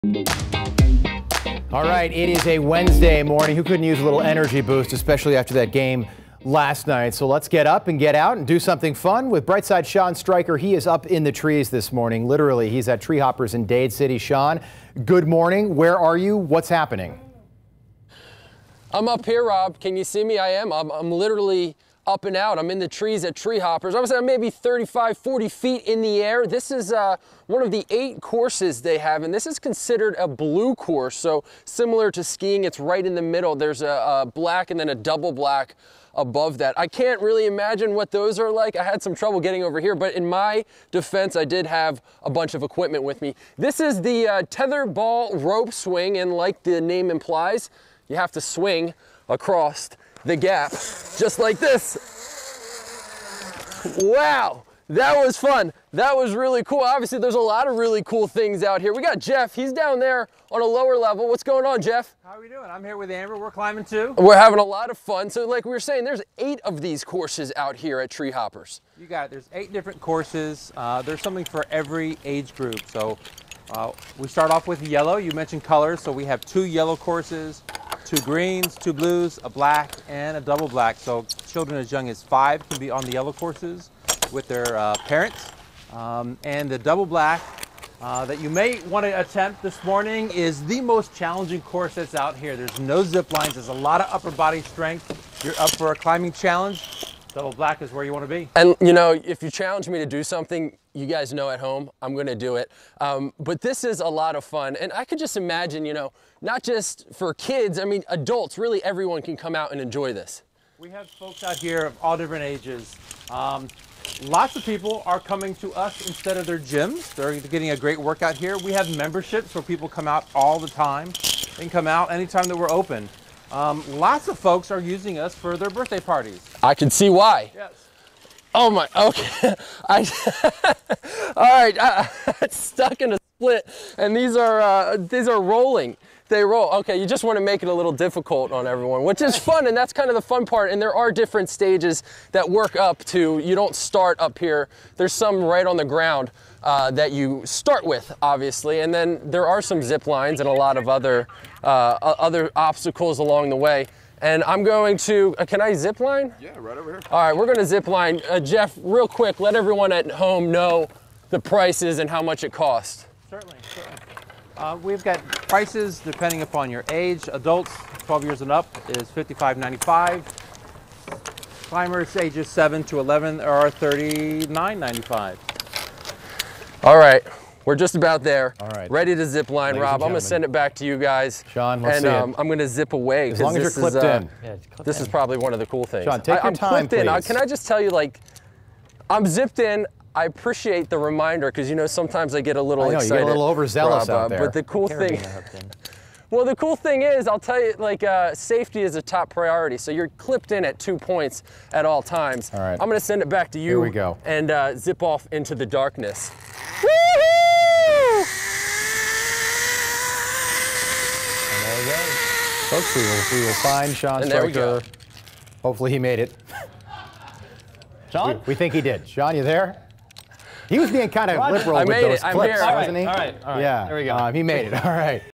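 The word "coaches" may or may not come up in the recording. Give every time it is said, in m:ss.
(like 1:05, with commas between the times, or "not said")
not said.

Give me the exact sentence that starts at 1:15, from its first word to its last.
You mentioned colors, so we have two yellow courses two greens, two blues, a black, and a double black.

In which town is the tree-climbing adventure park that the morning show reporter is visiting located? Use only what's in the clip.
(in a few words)
Dade City.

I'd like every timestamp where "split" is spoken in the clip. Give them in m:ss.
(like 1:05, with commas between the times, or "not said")
2:13.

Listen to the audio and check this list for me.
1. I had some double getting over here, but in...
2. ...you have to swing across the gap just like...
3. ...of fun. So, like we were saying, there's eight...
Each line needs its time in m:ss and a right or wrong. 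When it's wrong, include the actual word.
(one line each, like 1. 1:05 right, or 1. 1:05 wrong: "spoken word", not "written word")
1. 0:38 wrong: "trouble", not "double"
2. 0:48 right
3. 1:04 right.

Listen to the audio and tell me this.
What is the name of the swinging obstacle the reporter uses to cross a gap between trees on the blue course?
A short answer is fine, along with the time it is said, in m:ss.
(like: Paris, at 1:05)
tether ball rope swing, at 0:44.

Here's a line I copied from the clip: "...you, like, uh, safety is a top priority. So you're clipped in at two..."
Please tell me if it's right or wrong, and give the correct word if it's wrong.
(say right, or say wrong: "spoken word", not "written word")
right.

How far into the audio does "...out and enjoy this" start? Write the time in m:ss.
1:49.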